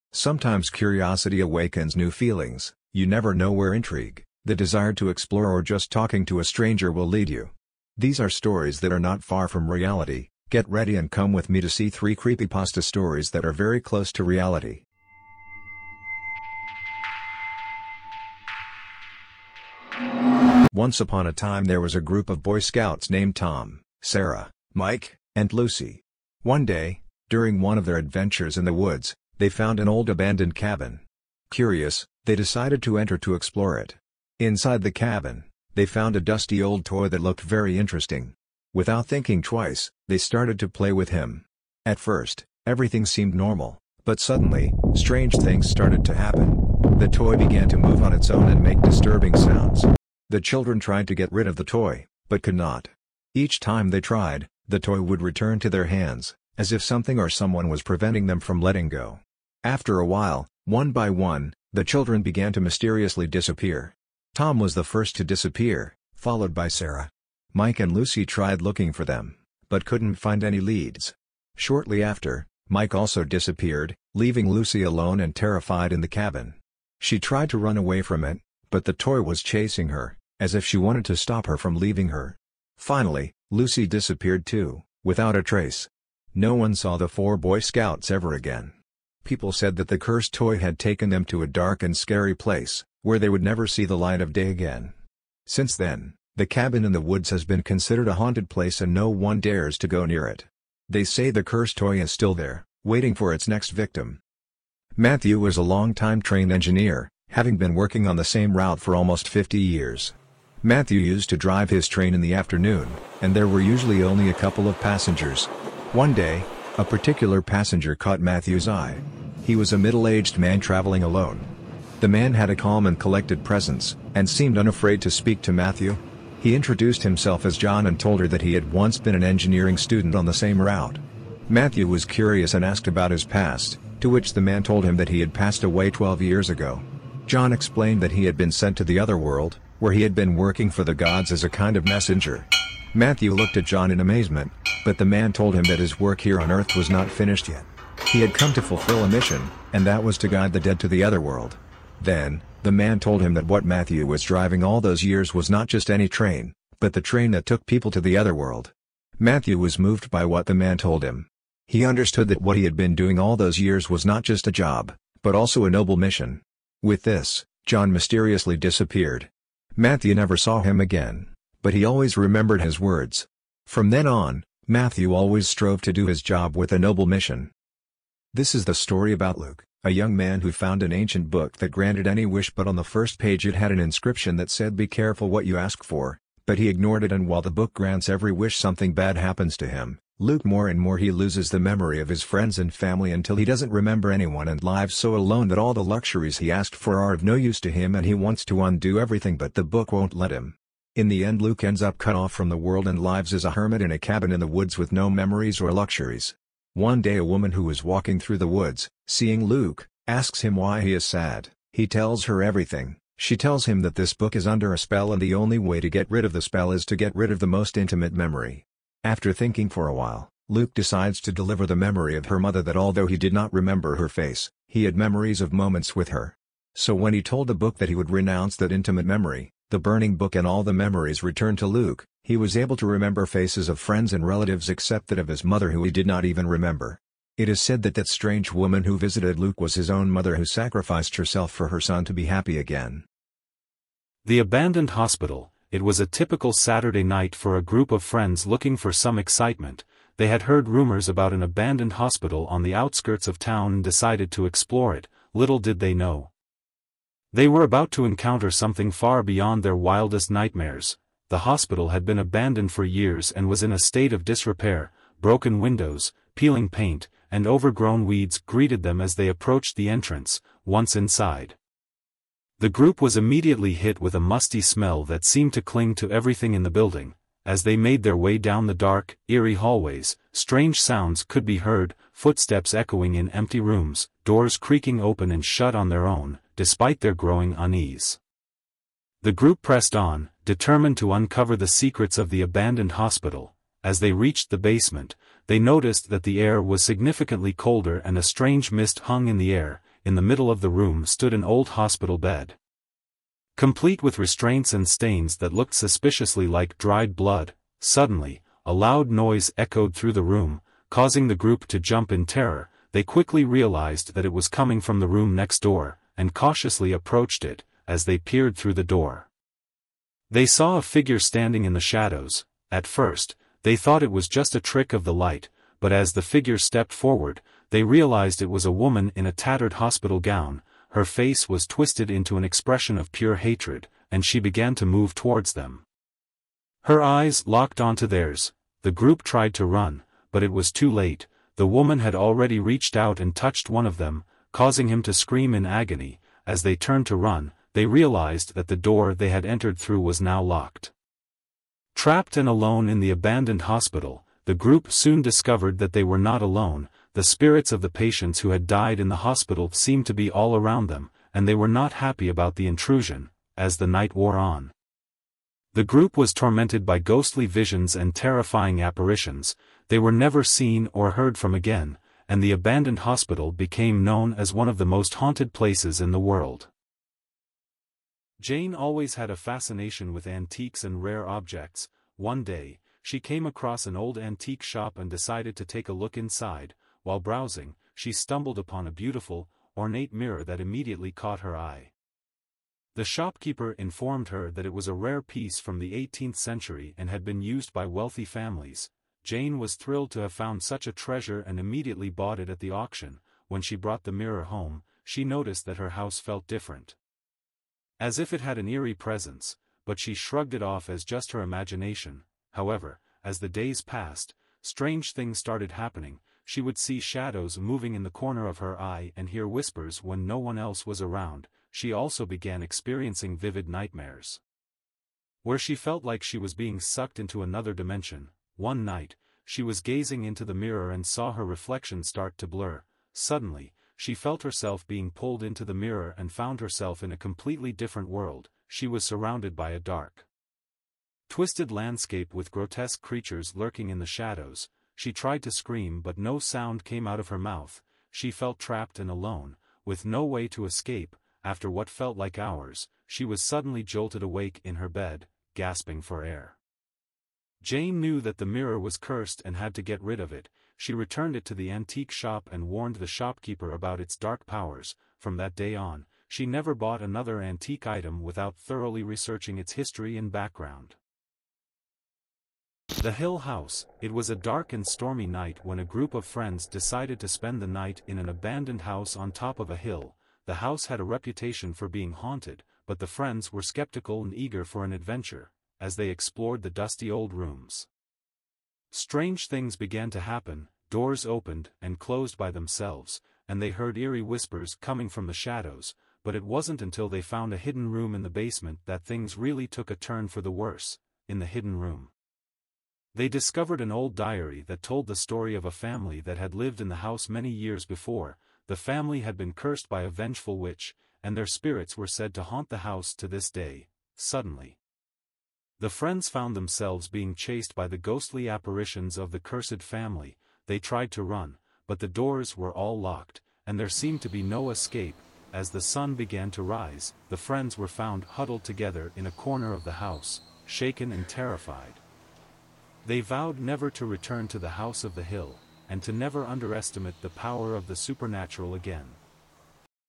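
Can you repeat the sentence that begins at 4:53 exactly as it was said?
As they reached the basement, they noticed that the air was significantly colder and a strange mist hung in the air.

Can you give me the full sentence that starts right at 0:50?
The children tried to get rid of the toy, but could not.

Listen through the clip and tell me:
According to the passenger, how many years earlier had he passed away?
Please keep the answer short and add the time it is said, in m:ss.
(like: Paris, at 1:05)
12 years, at 2:15.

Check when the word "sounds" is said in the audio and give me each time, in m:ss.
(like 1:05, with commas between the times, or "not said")
0:49, 4:40, 7:26.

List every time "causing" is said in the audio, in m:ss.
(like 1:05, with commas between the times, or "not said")
5:10, 5:44.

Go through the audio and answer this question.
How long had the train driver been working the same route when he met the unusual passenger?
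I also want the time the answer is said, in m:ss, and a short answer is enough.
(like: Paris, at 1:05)
almost 50 years, at 1:48.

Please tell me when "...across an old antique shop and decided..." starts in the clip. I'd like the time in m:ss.
6:23.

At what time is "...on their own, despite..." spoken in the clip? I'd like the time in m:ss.
4:45.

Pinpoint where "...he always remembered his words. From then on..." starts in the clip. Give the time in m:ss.
2:51.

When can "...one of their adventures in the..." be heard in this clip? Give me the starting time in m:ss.
0:27.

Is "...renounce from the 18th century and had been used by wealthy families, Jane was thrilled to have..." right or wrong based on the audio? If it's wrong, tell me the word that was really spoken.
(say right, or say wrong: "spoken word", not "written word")
wrong: "piece", not "renounce".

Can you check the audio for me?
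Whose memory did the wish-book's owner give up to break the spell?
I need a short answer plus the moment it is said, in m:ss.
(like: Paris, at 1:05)
his mother, at 3:41.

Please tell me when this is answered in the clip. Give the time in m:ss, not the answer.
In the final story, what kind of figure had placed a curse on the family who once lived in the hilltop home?
8:30.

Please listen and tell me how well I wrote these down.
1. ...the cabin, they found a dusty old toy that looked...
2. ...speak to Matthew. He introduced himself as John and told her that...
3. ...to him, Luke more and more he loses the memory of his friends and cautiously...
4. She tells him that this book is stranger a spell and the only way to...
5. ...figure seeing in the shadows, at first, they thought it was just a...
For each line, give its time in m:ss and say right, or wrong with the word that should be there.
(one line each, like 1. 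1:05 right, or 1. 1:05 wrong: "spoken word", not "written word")
1. 0:34 right
2. 2:05 right
3. 3:09 wrong: "family", not "cautiously"
4. 3:33 wrong: "under", not "stranger"
5. 5:20 wrong: "standing", not "seeing".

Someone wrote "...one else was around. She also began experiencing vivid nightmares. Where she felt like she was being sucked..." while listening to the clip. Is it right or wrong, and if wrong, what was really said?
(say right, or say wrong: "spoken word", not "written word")
right.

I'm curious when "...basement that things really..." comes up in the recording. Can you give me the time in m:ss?
8:18.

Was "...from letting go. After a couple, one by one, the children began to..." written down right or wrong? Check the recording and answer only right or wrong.
wrong.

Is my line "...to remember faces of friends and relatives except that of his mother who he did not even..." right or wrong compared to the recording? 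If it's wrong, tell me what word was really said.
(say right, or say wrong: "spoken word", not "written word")
right.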